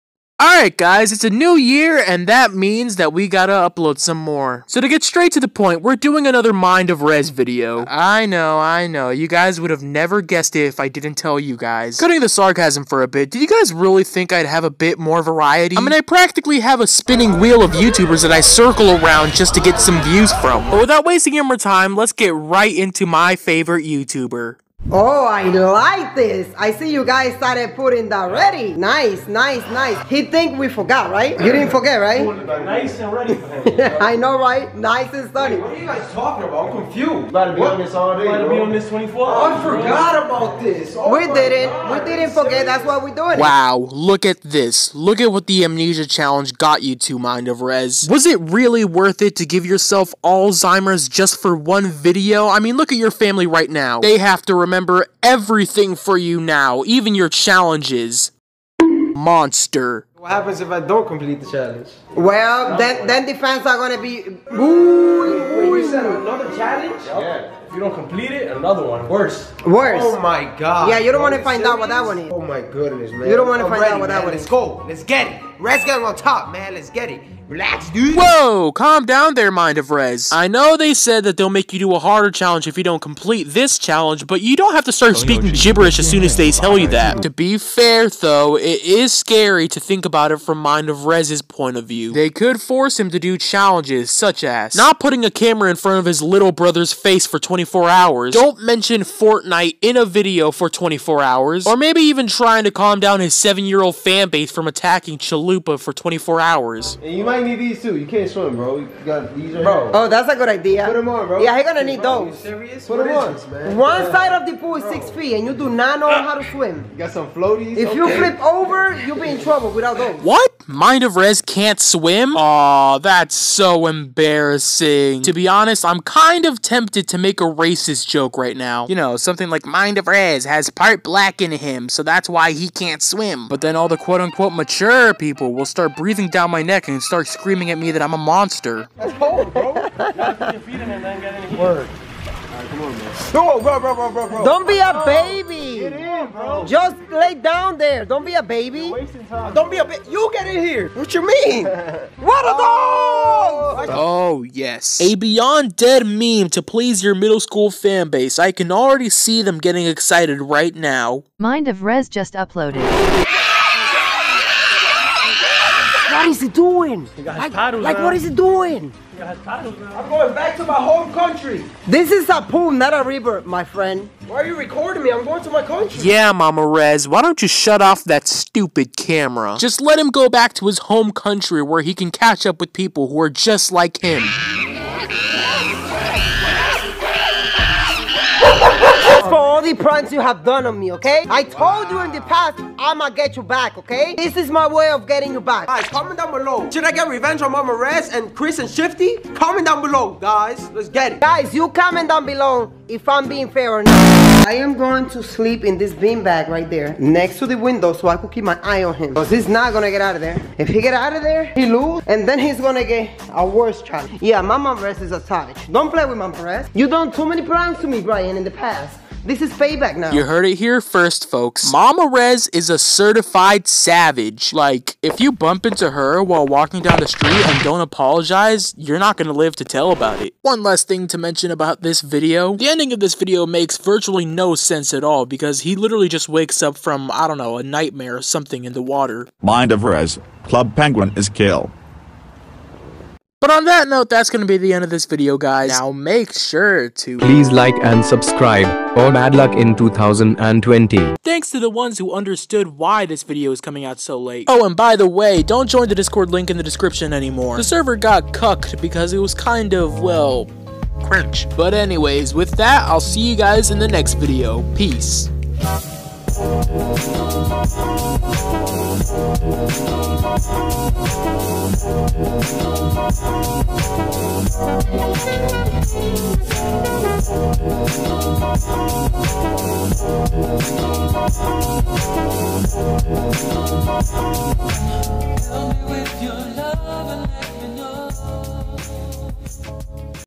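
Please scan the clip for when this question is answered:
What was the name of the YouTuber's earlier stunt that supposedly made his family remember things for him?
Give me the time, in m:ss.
0:45.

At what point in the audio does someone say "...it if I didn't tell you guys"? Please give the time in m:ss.
0:10.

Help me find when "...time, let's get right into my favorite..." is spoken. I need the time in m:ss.
0:21.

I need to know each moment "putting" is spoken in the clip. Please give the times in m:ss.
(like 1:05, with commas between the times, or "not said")
0:27, 1:35.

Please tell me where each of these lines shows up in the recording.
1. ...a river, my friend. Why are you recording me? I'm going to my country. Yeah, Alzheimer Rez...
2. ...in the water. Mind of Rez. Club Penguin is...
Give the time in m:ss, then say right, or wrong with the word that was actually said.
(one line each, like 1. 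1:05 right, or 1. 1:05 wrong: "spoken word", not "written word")
1. 2:52 wrong: "Mama", not "Alzheimer"
2. 3:58 right.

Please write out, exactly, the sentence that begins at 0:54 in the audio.
They have to remember remember everything for you now, even your challenges.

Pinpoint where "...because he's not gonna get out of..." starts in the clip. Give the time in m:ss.
3:29.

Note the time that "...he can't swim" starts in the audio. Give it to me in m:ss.
2:12.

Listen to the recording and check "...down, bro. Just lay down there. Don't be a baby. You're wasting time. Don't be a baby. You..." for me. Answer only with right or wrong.
right.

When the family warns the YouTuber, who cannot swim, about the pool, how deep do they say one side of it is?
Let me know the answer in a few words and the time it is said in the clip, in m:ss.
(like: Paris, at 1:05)
6 feet, at 1:54.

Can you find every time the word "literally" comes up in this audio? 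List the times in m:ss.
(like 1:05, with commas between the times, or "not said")
3:55.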